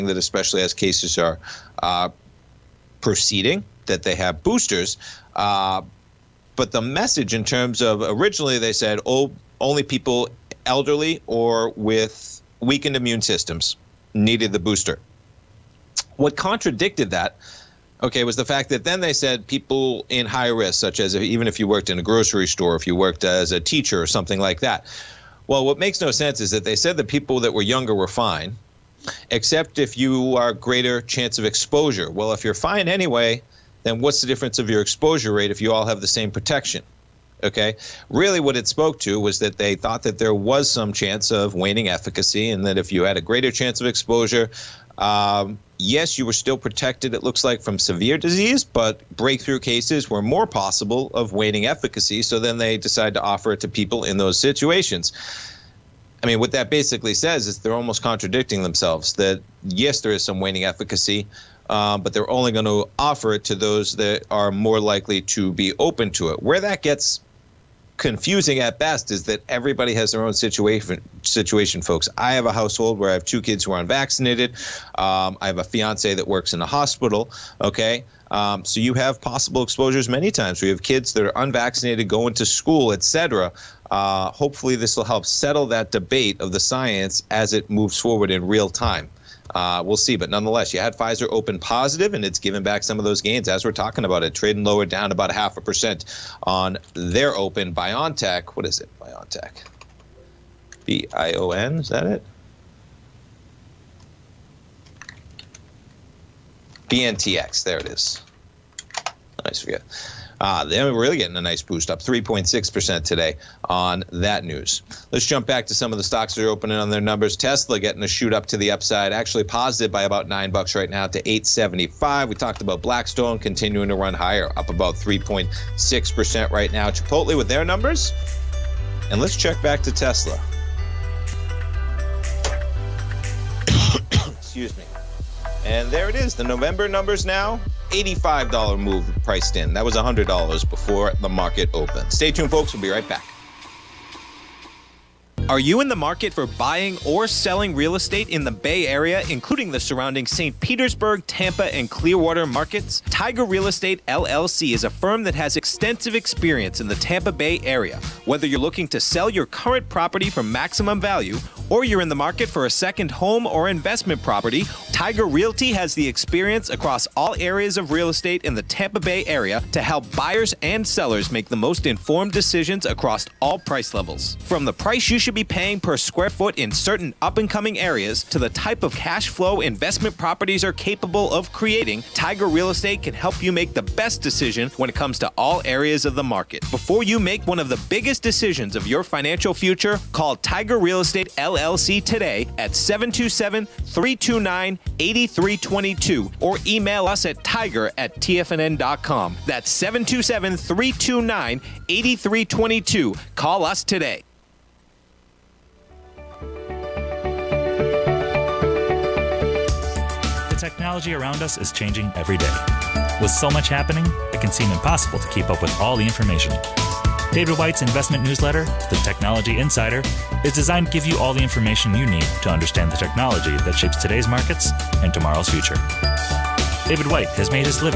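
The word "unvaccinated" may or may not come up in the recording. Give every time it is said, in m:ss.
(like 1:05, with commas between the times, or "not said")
1:13, 1:21.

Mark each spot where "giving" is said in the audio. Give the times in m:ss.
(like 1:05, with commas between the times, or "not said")
not said.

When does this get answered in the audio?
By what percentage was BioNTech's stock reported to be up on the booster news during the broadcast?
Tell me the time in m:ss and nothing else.
1:51.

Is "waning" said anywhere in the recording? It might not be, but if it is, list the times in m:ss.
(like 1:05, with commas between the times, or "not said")
0:41, 0:51, 1:00.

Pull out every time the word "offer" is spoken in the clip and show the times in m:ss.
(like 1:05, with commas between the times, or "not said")
0:53, 1:02.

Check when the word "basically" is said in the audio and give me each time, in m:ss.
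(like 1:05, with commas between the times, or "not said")
0:56.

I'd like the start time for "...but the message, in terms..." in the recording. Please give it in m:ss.
0:06.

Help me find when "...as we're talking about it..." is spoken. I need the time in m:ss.
1:33.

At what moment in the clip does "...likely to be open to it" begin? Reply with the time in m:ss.
1:04.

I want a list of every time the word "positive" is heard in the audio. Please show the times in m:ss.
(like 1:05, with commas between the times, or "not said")
1:31, 1:59.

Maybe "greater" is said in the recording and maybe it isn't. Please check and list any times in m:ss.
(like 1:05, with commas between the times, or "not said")
0:30, 0:43.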